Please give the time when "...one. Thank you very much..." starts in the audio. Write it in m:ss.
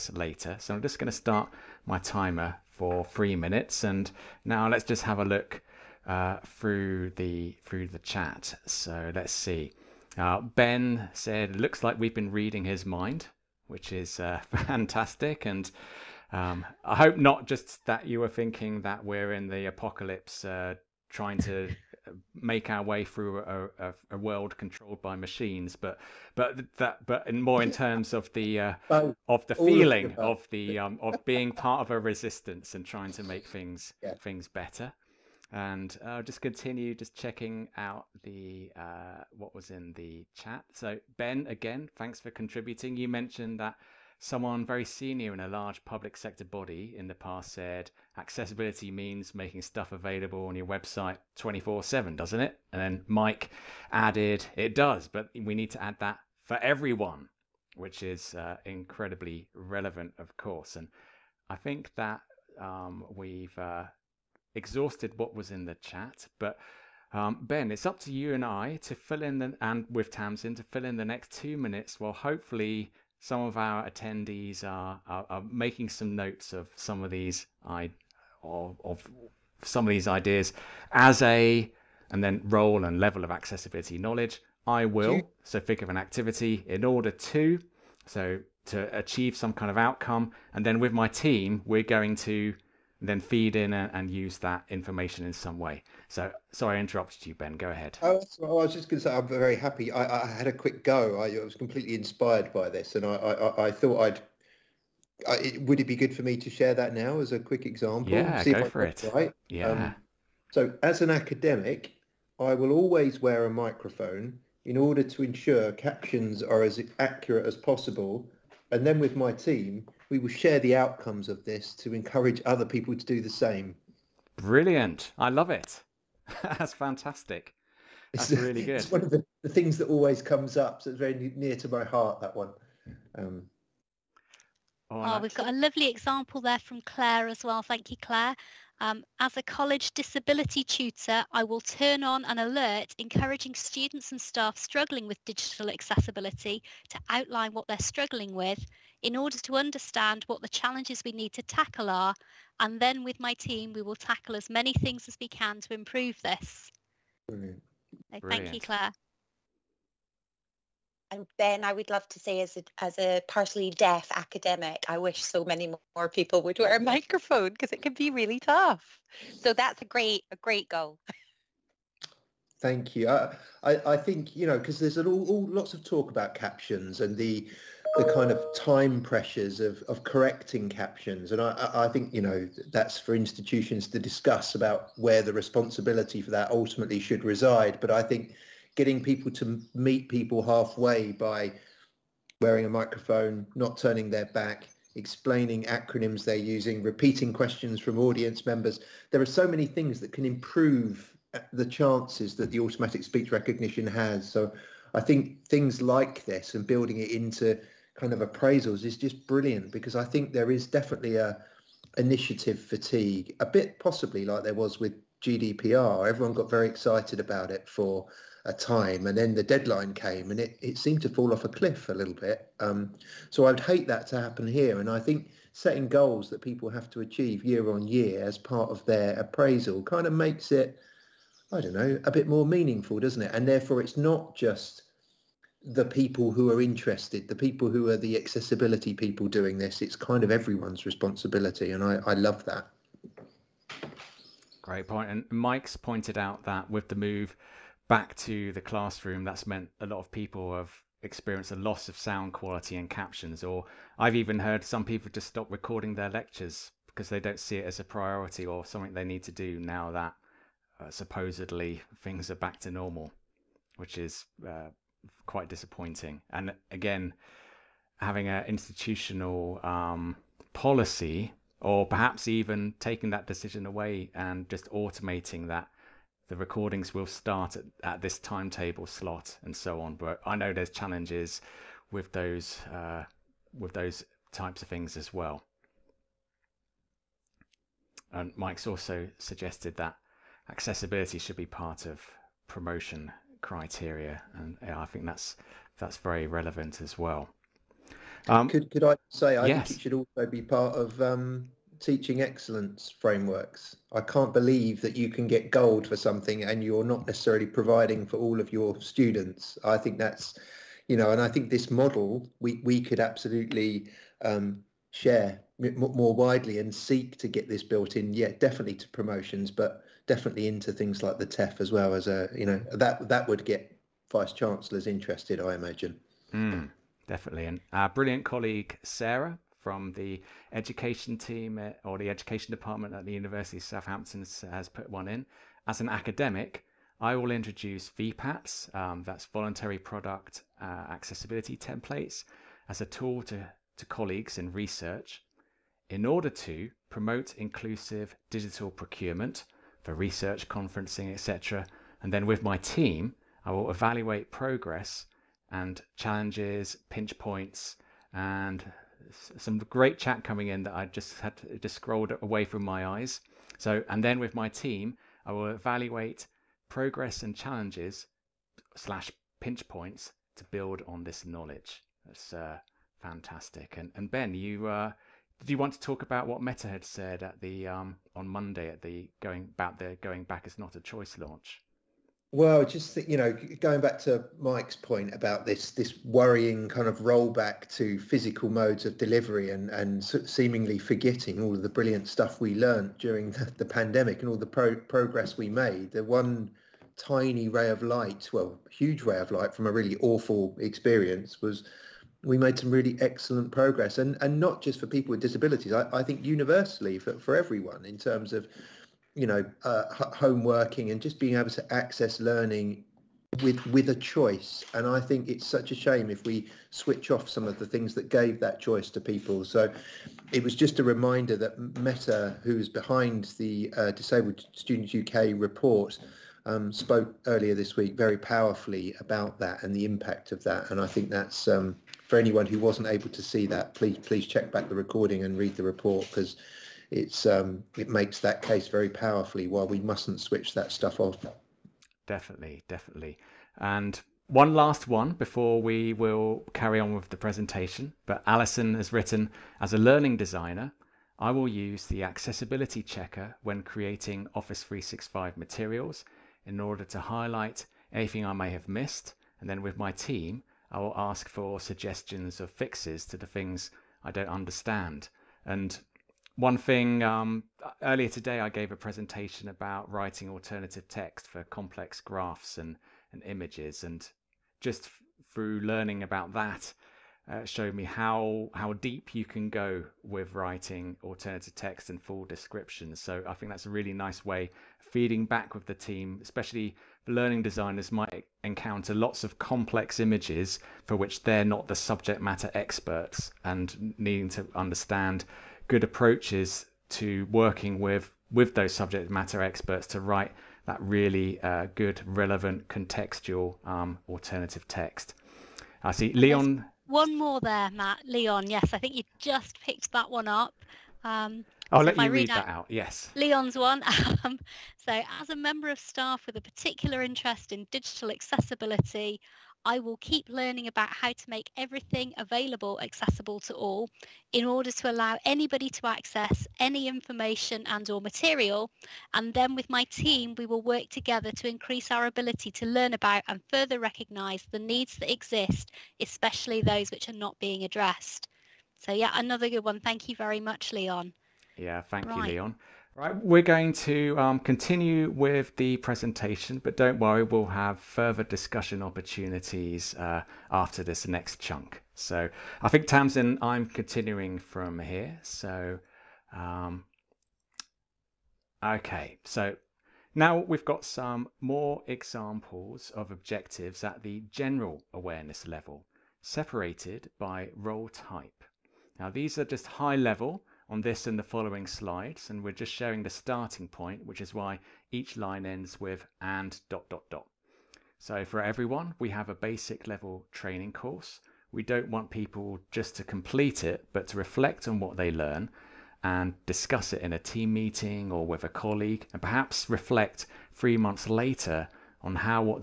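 8:59.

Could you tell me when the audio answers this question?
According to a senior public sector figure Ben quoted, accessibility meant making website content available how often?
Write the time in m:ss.
0:51.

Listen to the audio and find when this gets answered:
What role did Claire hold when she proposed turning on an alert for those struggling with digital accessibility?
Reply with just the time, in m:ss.
2:19.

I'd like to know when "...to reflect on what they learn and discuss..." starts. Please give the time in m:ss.
9:44.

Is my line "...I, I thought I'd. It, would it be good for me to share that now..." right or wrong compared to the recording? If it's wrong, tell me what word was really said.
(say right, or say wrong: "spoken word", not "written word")
right.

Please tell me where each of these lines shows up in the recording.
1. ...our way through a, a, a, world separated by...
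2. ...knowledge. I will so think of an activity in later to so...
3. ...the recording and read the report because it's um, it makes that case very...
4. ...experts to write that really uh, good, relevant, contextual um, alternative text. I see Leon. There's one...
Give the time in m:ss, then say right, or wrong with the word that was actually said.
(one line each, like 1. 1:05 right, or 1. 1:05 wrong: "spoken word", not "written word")
1. 0:22 wrong: "controlled", not "separated"
2. 1:23 wrong: "order", not "later"
3. 7:14 right
4. 8:19 right.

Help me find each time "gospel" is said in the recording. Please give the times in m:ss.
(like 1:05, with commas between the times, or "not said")
not said.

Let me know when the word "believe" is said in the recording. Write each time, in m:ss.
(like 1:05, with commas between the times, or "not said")
5:04.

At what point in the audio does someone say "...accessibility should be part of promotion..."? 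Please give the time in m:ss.
4:50.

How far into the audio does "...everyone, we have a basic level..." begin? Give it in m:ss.
9:38.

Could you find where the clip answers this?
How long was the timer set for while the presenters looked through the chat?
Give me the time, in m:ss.
0:03.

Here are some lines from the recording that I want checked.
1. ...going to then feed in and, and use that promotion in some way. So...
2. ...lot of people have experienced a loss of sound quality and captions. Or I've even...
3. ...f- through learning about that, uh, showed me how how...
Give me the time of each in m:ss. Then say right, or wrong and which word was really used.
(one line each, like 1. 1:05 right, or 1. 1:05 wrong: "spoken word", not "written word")
1. 1:31 wrong: "information", not "promotion"
2. 4:09 right
3. 7:54 right.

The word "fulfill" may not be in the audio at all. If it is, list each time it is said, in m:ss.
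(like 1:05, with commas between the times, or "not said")
not said.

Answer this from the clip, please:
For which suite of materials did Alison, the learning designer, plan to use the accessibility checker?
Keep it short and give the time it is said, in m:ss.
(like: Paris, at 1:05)
Office 365, at 7:34.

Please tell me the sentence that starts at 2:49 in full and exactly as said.
So that's a great a great goal.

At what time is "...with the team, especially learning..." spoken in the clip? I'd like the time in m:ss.
8:05.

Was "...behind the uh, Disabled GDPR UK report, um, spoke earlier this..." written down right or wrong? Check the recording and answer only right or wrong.
wrong.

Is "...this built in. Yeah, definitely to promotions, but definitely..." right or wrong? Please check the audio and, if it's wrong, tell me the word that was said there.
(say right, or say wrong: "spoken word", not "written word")
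right.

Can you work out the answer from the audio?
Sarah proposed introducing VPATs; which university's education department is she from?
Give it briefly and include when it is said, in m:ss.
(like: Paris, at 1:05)
University of Southampton, at 5:33.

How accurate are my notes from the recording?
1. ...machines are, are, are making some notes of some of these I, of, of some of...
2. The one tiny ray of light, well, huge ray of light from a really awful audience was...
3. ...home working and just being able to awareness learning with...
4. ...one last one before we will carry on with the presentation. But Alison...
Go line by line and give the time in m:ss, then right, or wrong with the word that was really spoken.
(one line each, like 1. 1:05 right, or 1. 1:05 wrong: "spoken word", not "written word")
1. 1:13 wrong: "attendees", not "machines"
2. 6:35 wrong: "experience", not "audience"
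3. 6:50 wrong: "access", not "awareness"
4. 7:24 right.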